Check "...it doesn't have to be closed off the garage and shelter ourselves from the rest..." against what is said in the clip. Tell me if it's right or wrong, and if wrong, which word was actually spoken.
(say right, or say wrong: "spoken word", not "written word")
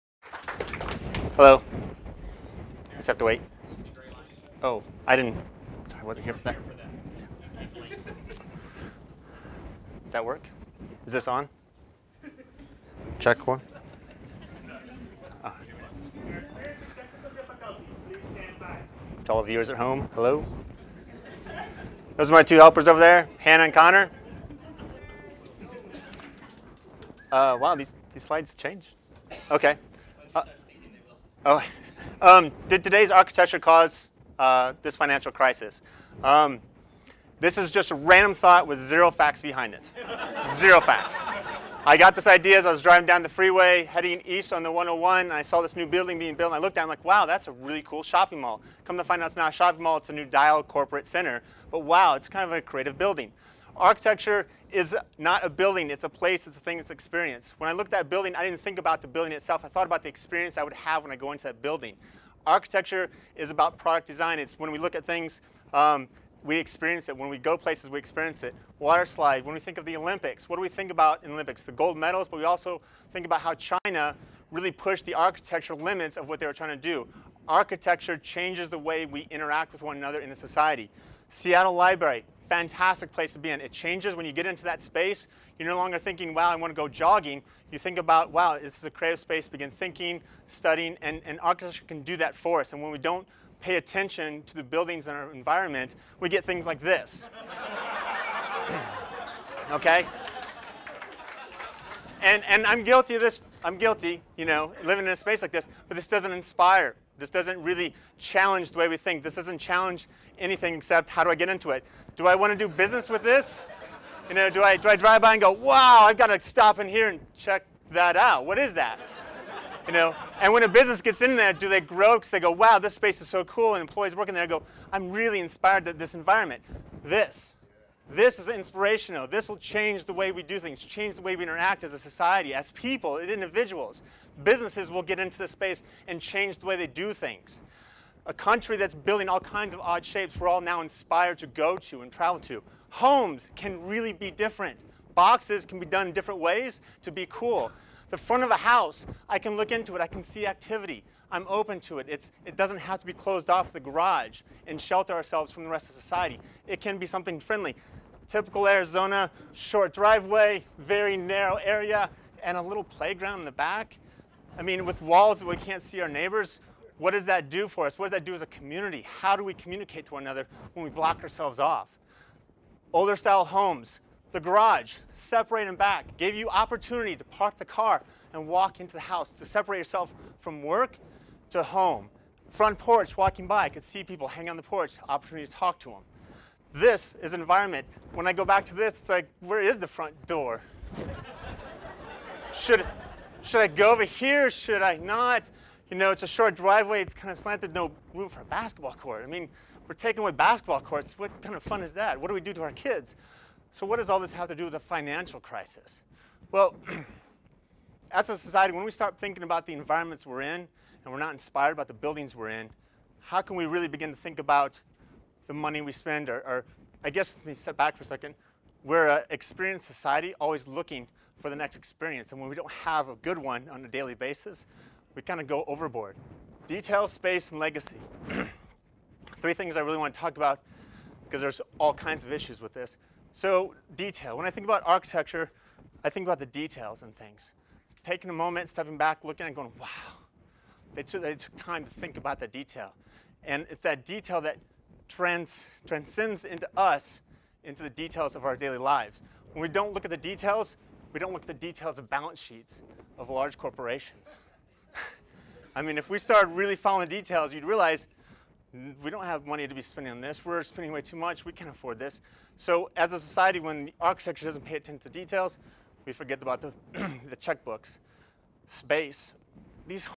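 right.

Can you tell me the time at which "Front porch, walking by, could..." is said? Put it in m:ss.
3:02.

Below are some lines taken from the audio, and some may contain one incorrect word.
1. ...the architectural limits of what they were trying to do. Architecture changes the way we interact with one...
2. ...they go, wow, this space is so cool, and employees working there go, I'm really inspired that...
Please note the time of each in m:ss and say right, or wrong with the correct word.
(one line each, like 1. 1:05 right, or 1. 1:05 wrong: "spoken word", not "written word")
1. 1:15 right
2. 2:02 right.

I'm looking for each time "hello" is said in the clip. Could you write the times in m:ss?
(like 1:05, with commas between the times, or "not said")
0:01, 0:20.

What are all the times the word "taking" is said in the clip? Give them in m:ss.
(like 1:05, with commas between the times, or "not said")
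3:19, 3:58.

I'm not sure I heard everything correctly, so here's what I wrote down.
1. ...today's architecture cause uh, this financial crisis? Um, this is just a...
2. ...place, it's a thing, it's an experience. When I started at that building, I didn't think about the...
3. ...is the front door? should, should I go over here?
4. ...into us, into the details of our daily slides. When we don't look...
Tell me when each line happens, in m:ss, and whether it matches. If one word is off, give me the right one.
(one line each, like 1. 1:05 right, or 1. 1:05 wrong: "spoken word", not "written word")
1. 0:32 right
2. 0:56 wrong: "looked", not "started"
3. 3:09 right
4. 4:06 wrong: "lives", not "slides".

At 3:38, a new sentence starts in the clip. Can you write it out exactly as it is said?
We're an experienced society, always looking for the next experience.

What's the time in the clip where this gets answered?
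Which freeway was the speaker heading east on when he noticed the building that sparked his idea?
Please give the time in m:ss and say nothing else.
0:44.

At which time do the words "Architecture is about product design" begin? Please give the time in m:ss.
1:02.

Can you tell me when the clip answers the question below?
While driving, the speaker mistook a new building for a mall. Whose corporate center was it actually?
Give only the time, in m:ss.
0:50.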